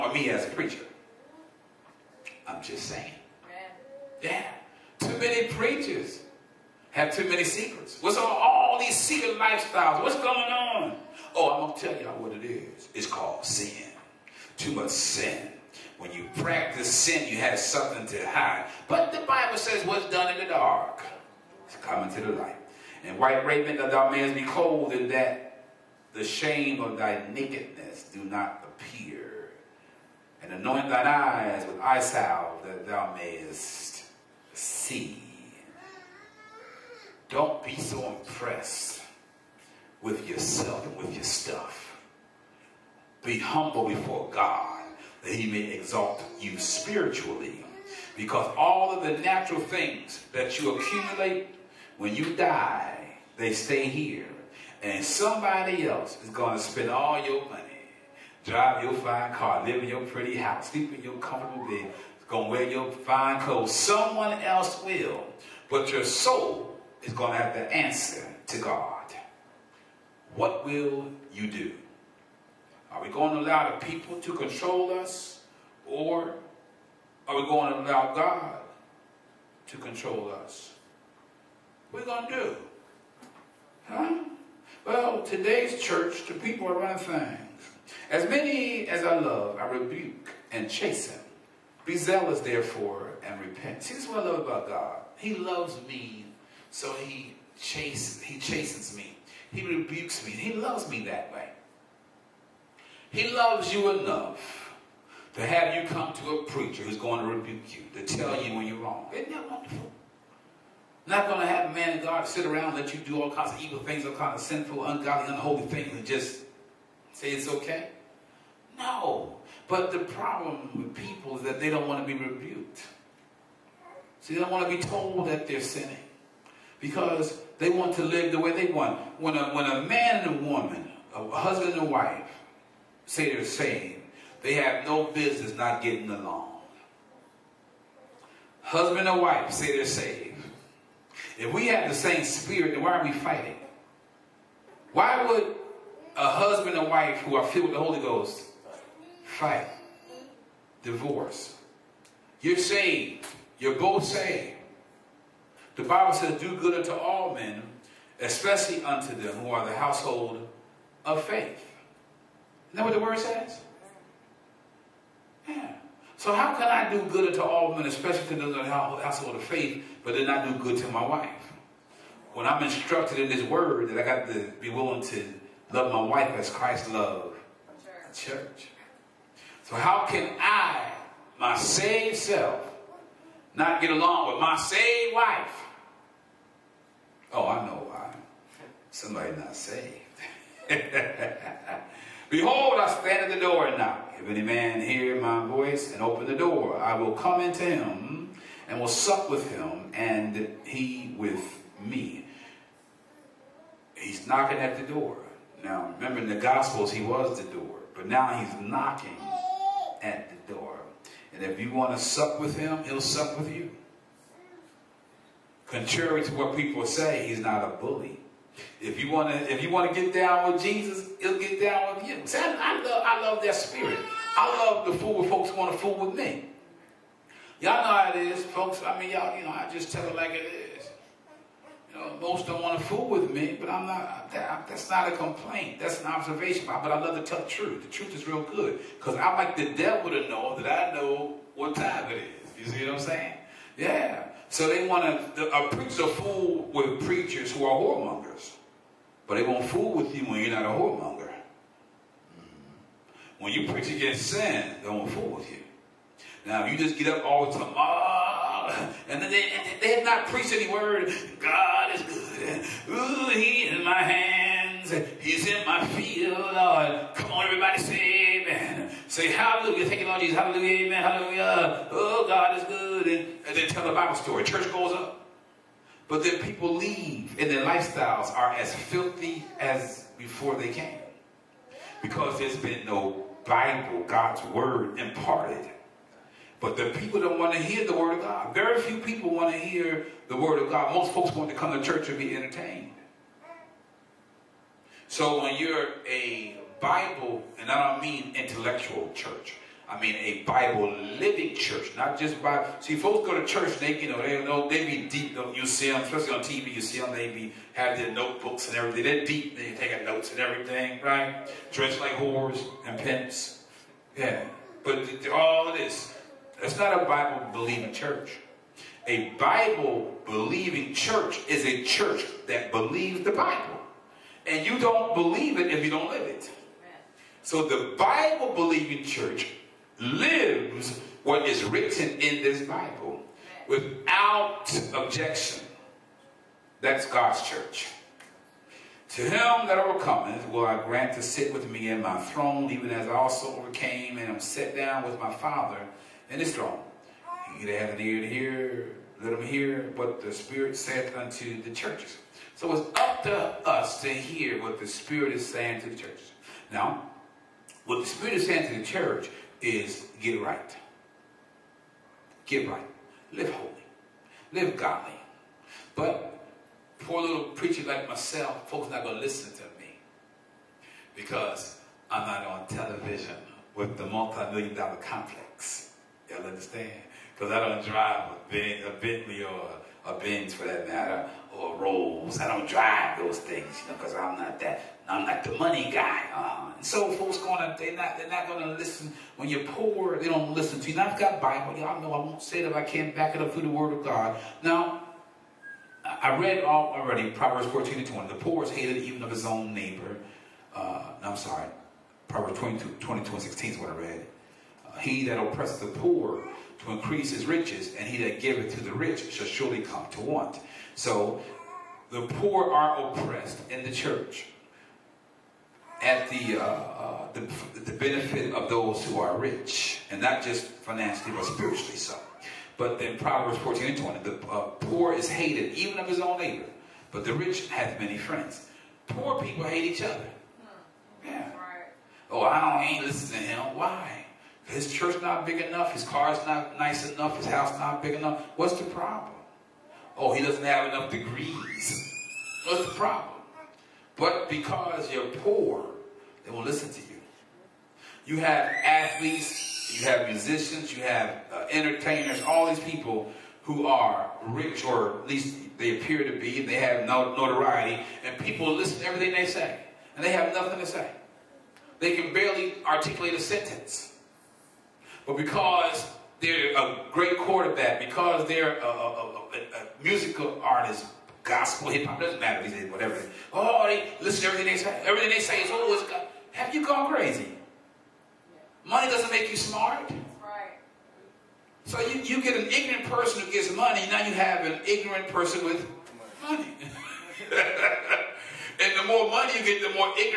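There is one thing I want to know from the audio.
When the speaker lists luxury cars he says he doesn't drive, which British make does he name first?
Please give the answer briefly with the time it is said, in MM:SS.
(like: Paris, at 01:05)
Bentley, at 06:19.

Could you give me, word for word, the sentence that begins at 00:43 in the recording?
Be humble before God that he may exalt you spiritually.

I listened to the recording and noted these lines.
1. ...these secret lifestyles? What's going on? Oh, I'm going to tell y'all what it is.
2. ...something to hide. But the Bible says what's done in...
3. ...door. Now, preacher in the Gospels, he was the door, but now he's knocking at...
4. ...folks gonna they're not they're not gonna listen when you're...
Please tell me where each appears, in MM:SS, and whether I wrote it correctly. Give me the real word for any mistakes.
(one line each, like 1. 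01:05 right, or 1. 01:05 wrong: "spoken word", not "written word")
1. 00:08 right
2. 00:17 right
3. 03:24 wrong: "remember", not "preacher"
4. 06:27 right.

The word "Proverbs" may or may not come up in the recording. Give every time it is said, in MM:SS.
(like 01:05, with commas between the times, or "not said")
06:37, 06:42, 07:03.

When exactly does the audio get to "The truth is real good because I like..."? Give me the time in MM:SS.
03:57.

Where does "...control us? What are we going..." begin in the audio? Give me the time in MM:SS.
01:19.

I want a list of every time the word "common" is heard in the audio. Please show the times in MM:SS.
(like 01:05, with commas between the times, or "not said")
not said.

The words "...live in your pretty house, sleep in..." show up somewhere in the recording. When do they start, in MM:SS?
00:59.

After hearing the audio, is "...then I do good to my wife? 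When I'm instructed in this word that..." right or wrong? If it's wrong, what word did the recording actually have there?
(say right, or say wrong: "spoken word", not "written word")
right.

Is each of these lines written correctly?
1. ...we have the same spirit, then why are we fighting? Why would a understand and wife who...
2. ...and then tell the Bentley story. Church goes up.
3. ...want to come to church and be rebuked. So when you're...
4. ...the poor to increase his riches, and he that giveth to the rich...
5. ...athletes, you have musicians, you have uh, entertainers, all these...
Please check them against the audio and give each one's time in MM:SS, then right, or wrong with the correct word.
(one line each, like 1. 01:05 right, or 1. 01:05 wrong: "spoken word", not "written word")
1. 02:21 wrong: "husband", not "understand"
2. 04:33 wrong: "Bible", not "Bentley"
3. 04:51 wrong: "entertained", not "rebuked"
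4. 06:45 right
5. 07:28 right.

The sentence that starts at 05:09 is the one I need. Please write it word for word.
They taking notes and everything, right?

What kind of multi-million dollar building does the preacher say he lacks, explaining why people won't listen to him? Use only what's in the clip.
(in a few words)
Complex.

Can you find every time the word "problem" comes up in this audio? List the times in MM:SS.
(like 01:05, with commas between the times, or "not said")
02:00, 07:18, 07:22.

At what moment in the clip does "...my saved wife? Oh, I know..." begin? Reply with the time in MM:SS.
03:04.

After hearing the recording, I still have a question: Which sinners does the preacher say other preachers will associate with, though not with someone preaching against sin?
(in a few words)
Whoremongers.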